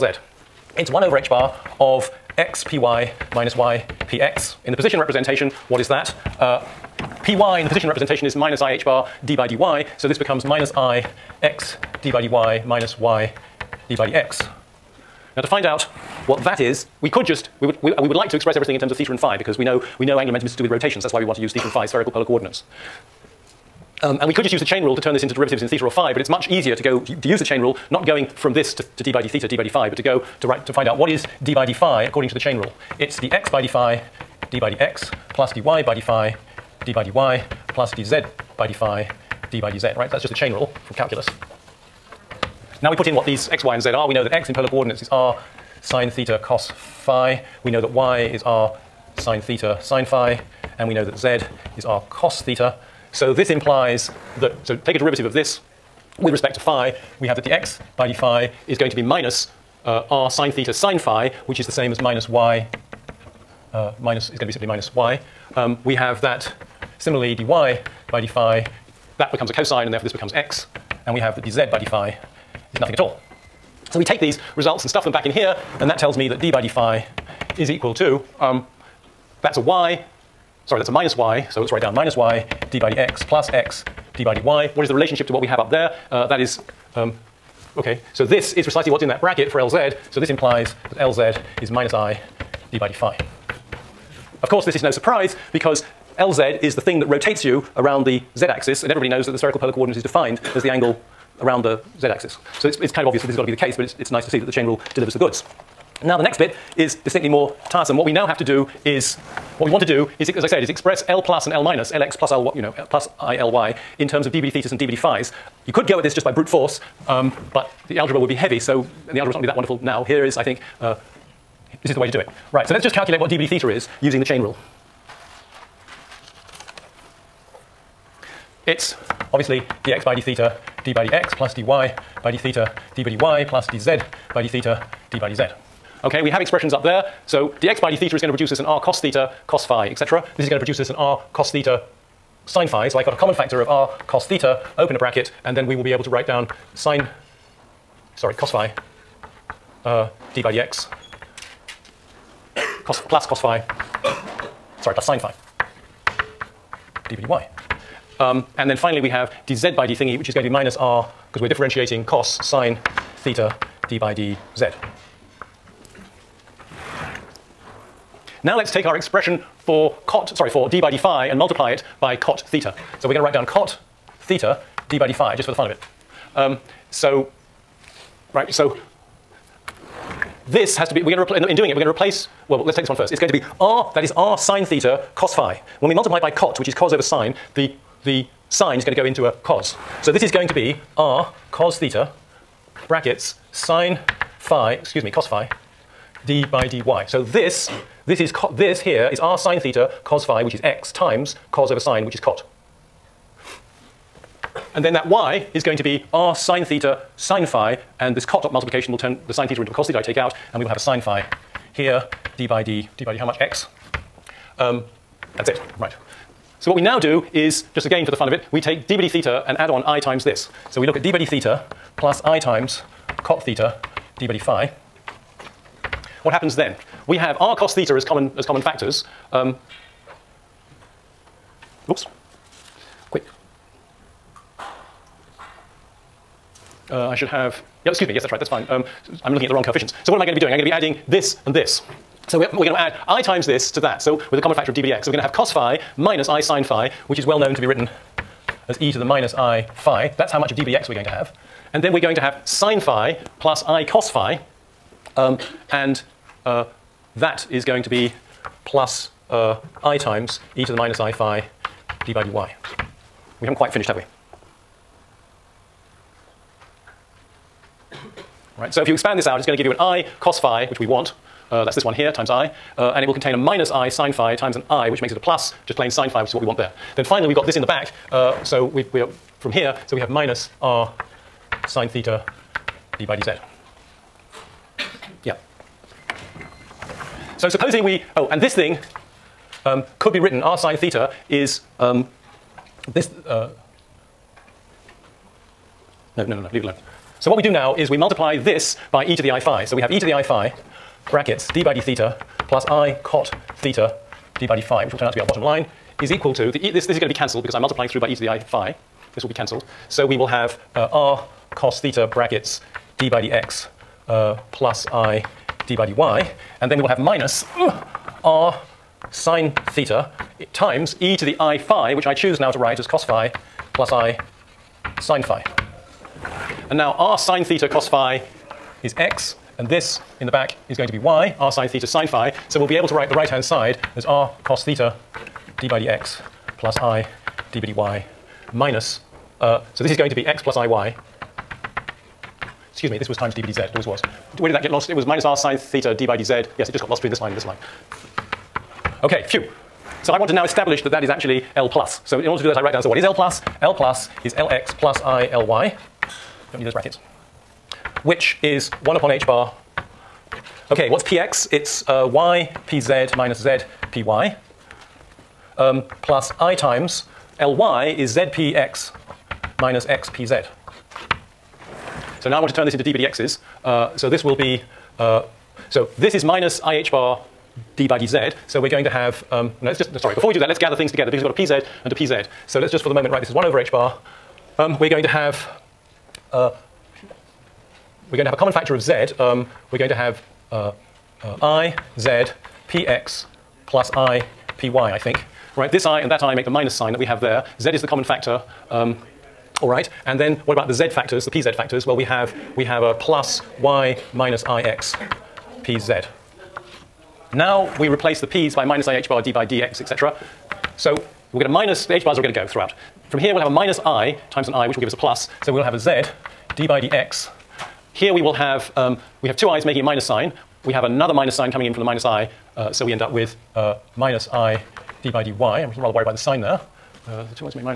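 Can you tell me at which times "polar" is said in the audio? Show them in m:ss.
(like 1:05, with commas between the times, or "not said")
0:22, 0:44, 1:39.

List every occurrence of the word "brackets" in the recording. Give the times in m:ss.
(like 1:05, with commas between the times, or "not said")
1:29, 2:24, 3:12, 5:01, 5:12, 5:56.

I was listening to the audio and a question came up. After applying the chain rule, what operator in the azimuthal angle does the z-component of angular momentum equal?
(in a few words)
minus i d by d phi.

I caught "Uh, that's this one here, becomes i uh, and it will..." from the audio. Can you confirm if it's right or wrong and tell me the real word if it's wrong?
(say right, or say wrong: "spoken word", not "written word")
wrong: "times", not "becomes".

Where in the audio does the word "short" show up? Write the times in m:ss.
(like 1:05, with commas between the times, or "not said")
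not said.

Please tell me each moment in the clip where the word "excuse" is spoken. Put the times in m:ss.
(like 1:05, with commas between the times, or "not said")
3:14, 3:57, 5:42.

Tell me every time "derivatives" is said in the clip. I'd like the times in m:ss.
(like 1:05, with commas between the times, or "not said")
0:25, 0:54.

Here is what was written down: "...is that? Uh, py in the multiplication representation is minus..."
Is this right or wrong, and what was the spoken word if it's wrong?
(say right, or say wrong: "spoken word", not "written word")
wrong: "position", not "multiplication".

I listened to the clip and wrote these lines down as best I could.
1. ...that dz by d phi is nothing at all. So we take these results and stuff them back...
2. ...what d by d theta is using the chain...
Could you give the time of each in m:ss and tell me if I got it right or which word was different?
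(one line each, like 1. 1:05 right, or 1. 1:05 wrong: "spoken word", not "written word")
1. 1:11 right
2. 2:03 right.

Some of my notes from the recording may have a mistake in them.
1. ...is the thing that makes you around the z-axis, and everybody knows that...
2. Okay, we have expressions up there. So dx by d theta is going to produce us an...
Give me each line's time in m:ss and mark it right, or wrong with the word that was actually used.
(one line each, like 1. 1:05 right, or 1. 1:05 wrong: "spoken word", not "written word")
1. 1:36 wrong: "rotates", not "makes"
2. 2:16 right.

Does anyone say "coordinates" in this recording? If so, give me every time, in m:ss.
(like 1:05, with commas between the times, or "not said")
0:22, 0:44, 1:39.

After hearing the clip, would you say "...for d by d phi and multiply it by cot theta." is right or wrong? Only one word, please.
right.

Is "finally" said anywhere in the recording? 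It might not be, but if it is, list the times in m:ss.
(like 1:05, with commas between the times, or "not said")
2:38, 4:37.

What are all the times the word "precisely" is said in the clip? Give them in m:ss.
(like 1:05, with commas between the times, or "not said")
1:28.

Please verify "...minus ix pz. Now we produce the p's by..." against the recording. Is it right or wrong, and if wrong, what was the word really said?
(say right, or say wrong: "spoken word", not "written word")
wrong: "replace", not "produce".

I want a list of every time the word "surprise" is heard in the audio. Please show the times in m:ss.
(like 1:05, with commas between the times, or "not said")
1:34.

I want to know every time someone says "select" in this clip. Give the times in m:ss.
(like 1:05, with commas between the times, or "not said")
not said.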